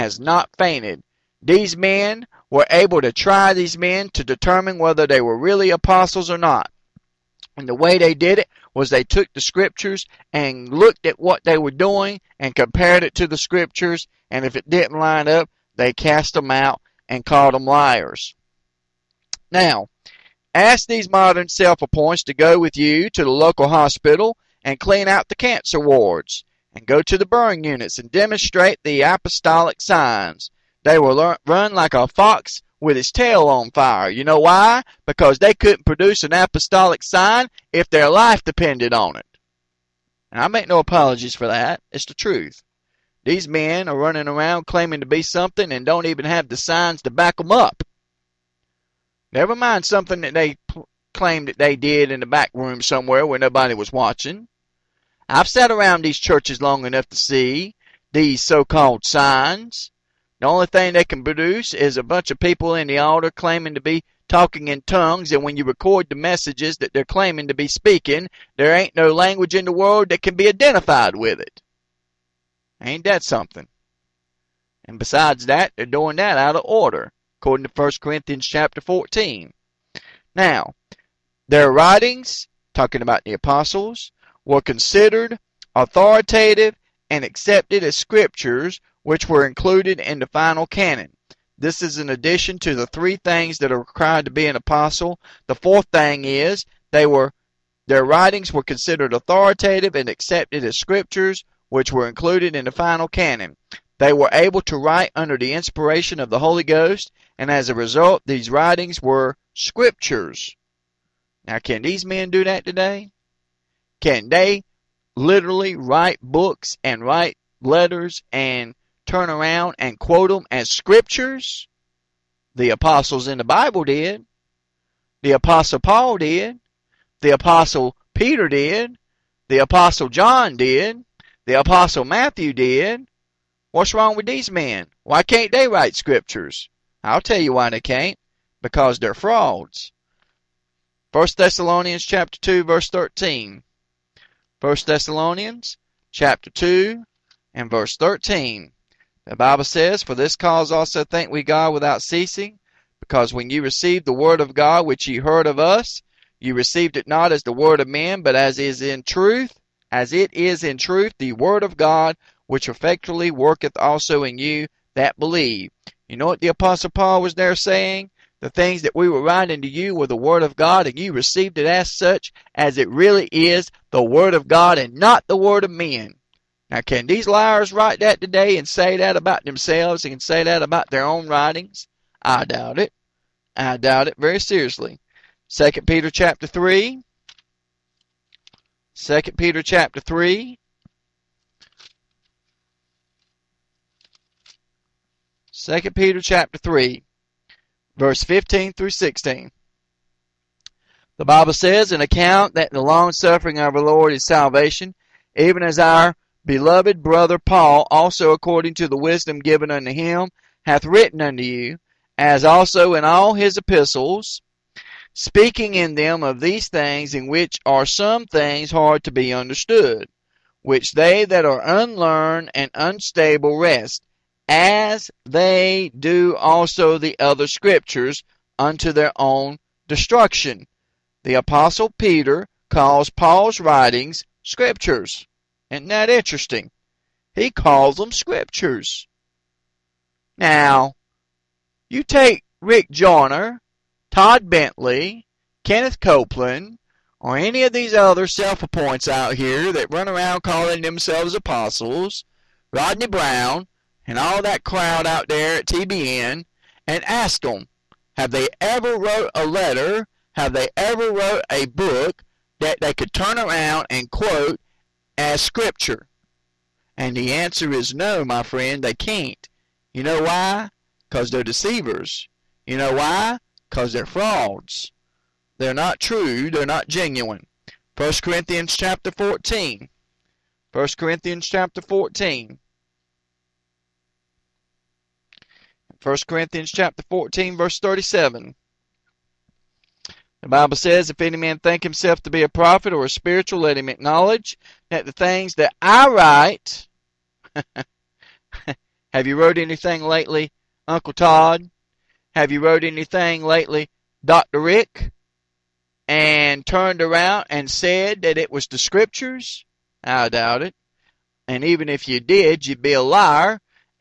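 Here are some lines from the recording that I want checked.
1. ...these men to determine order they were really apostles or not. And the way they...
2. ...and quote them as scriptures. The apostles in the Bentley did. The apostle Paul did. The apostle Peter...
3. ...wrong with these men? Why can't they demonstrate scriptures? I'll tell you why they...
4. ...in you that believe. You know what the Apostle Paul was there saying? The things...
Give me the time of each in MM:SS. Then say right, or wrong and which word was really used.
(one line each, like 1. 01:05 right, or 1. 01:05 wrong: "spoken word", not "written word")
1. 00:03 wrong: "whether", not "order"
2. 01:59 wrong: "Bible", not "Bentley"
3. 02:13 wrong: "write", not "demonstrate"
4. 02:44 right.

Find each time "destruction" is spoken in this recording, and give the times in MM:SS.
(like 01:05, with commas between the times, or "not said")
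03:49.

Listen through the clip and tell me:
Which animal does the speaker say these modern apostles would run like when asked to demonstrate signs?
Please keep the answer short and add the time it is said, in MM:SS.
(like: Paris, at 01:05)
a fox, at 00:31.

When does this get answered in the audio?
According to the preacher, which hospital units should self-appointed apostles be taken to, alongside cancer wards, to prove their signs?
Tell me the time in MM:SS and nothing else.
00:27.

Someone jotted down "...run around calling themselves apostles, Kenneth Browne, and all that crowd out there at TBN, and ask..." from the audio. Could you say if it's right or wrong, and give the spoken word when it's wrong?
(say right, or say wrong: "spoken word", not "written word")
wrong: "Rodney", not "Kenneth".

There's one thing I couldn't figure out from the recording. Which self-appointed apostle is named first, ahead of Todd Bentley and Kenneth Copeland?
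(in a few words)
Rick Joyner.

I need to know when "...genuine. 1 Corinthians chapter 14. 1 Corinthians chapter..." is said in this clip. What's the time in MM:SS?
04:36.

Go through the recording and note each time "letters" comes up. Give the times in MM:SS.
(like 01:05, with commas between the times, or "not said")
01:57, 04:19.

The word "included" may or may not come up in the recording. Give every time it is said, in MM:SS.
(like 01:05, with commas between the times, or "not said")
01:29, 01:42.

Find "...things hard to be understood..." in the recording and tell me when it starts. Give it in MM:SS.
03:38.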